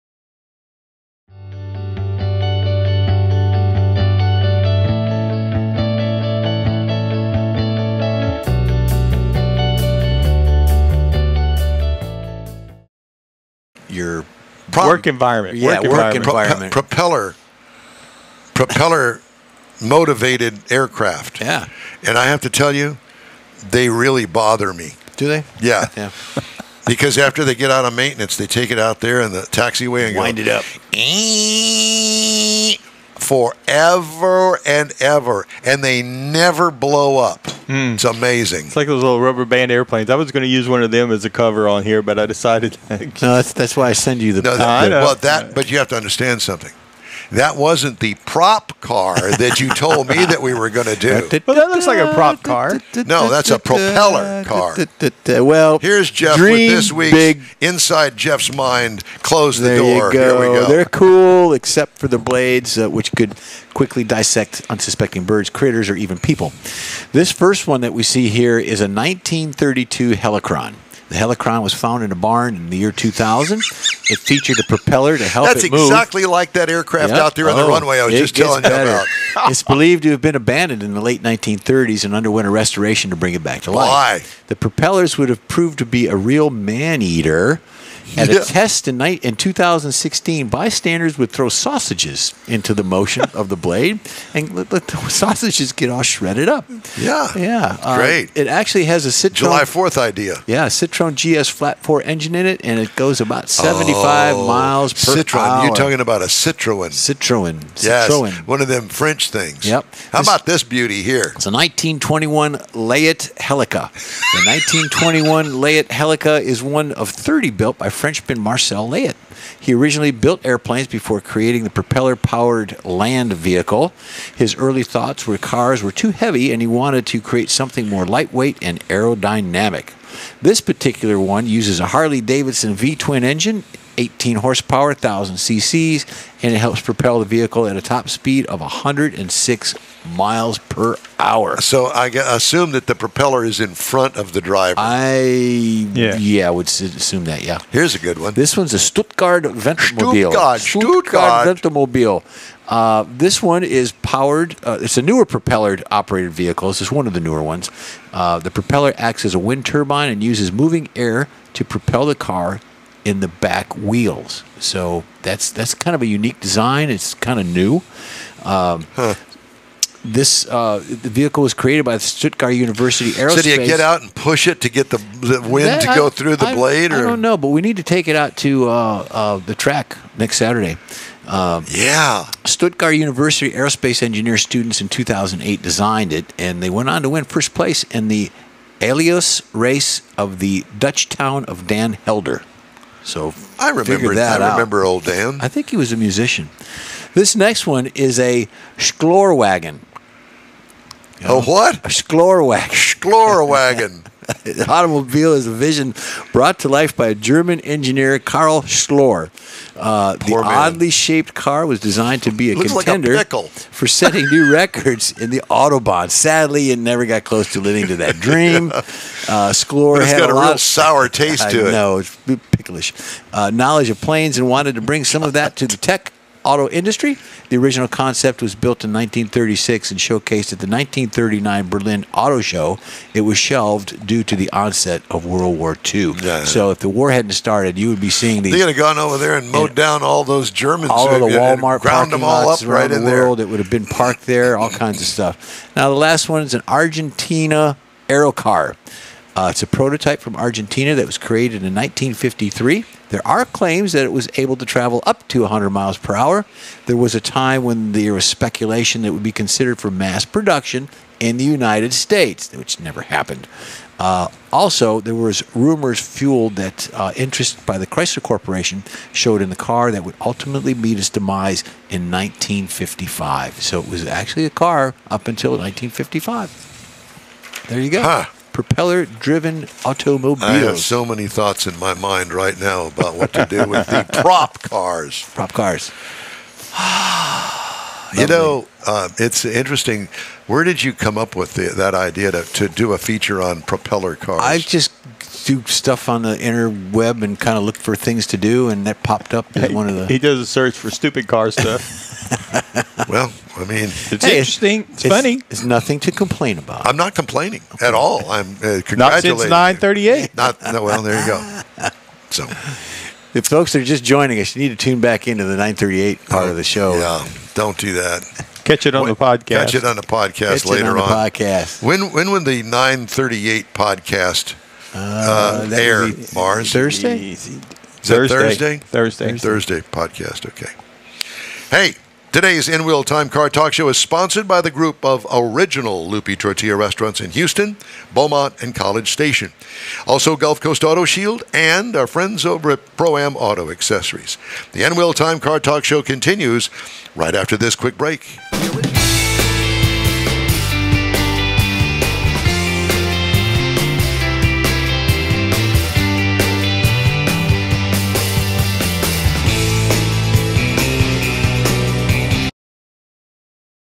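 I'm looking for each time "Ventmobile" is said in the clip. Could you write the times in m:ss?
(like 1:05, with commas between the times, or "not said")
2:29.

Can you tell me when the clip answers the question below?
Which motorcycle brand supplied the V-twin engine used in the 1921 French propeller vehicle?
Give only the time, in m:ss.
2:11.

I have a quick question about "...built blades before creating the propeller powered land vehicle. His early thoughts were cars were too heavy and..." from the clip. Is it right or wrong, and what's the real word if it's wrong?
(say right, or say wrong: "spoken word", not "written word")
wrong: "airplanes", not "blades".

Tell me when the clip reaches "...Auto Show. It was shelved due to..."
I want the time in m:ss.
3:52.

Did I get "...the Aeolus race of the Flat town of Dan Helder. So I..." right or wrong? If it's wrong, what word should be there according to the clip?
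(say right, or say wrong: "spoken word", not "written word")
wrong: "Dutch", not "Flat".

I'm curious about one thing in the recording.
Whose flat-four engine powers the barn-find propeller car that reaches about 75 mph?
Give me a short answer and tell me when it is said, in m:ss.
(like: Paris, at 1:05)
Citroen GS, at 1:40.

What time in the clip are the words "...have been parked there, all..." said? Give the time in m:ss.
4:03.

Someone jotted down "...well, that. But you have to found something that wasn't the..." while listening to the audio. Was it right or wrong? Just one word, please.
wrong.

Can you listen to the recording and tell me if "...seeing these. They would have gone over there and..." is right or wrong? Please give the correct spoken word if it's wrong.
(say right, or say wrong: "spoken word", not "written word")
right.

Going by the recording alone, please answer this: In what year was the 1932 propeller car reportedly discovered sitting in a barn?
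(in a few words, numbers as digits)
2000.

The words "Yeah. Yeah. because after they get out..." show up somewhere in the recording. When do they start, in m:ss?
0:25.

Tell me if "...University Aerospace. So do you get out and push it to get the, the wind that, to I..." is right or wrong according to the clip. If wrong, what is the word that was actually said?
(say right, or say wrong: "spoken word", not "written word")
right.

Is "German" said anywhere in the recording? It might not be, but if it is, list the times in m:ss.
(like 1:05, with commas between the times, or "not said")
3:27, 4:00.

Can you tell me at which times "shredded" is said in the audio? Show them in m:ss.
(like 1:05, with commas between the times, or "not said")
1:36.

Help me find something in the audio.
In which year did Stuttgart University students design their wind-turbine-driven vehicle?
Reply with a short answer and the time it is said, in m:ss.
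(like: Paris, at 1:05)
2008, at 3:04.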